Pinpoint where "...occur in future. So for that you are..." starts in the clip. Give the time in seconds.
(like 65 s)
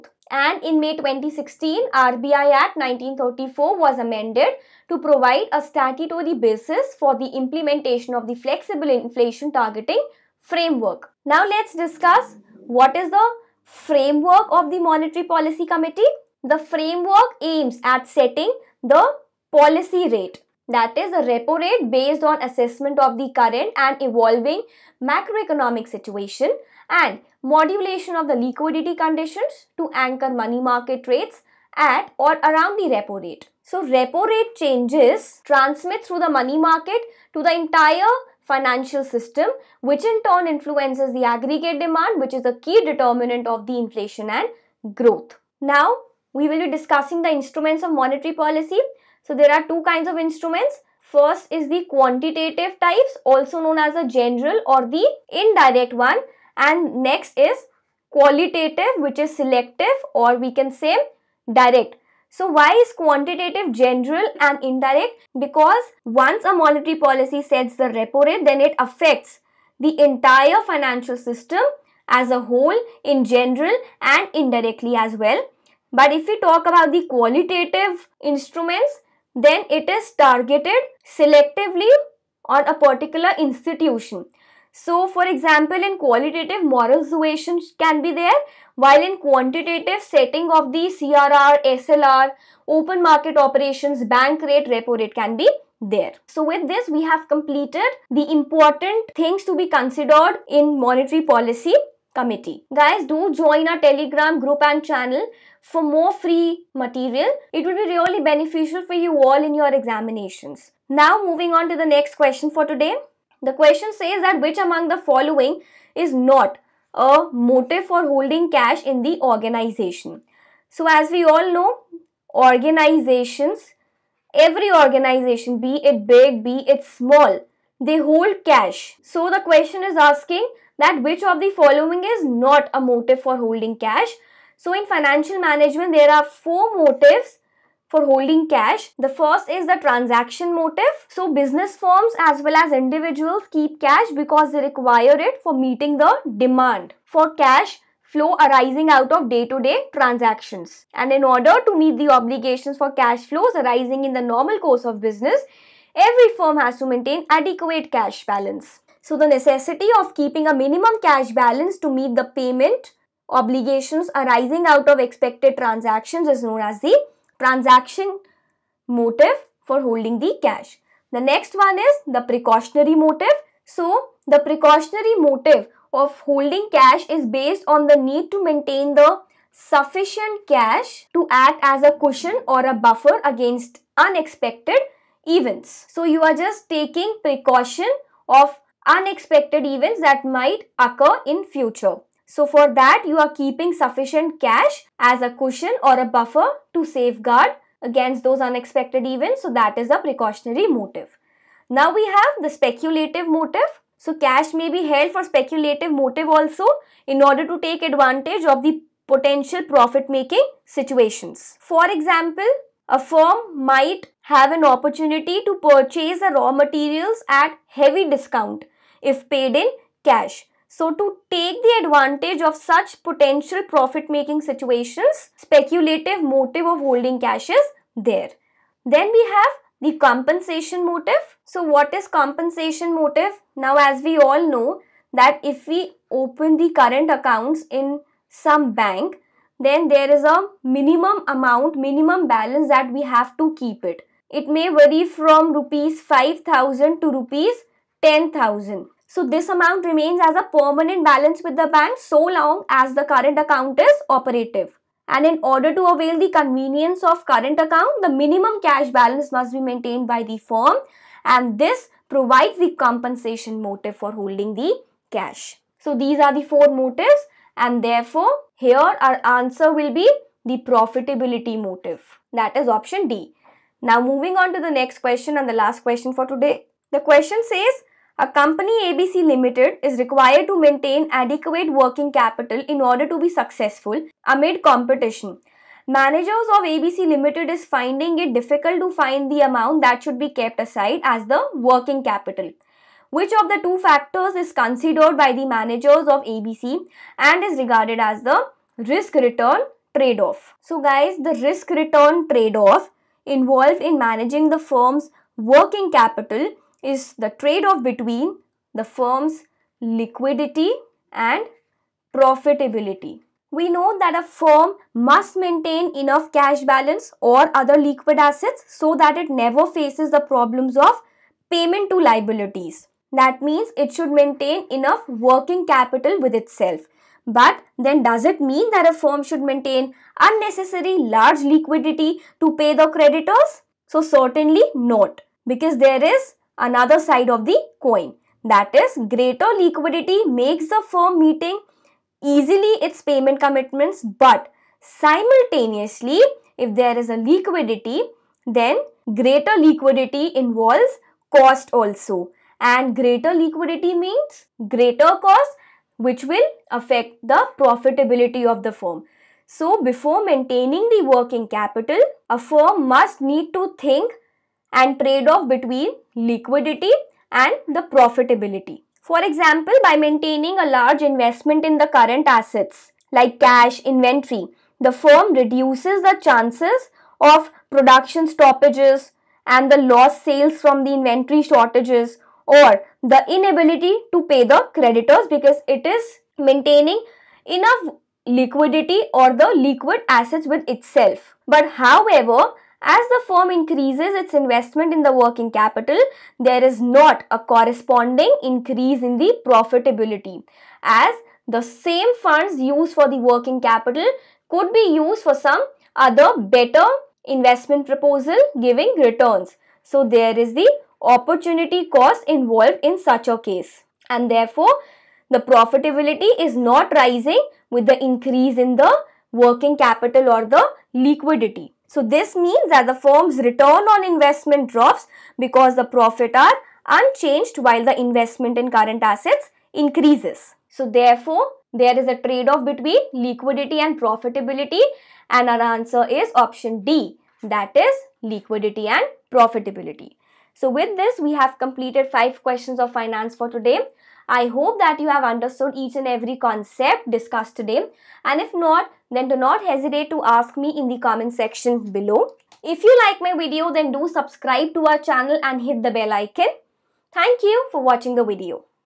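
190 s.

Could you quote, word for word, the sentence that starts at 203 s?
So cash may be held for speculative motive also in order to take advantage of the potential profit making situations.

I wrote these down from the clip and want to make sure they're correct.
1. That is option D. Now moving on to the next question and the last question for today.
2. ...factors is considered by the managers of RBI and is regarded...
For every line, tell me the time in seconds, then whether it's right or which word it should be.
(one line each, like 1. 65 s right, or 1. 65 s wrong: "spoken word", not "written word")
1. 272 s right
2. 293 s wrong: "ABC", not "RBI".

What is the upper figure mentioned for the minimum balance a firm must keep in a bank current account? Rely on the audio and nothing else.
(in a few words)
Rs 10,000.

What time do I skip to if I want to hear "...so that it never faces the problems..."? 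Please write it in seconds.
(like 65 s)
318 s.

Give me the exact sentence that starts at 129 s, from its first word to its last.
So the question is asking that which of the following is not a motive for holding cash.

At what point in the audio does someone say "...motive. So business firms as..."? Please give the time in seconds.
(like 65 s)
140 s.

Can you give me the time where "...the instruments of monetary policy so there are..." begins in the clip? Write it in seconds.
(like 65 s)
47 s.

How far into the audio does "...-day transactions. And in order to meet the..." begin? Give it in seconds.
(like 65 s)
149 s.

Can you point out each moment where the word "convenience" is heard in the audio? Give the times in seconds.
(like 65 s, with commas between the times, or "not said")
256 s.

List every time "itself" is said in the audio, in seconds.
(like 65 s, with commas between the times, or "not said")
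326 s, 390 s.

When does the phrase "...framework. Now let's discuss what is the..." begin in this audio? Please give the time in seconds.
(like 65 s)
10 s.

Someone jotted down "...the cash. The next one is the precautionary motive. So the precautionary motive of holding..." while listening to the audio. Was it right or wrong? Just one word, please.
right.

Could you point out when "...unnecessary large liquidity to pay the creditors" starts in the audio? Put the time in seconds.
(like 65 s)
330 s.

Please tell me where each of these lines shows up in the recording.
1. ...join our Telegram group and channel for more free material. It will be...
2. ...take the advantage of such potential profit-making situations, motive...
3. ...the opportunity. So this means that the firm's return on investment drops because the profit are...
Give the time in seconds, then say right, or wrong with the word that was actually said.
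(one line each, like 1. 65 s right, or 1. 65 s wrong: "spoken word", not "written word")
1. 103 s right
2. 221 s wrong: "speculative", not "motive"
3. 420 s wrong: "liquidity", not "opportunity".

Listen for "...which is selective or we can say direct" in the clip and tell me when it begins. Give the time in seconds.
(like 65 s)
58 s.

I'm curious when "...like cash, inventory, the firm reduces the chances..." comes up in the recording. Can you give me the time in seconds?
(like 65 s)
373 s.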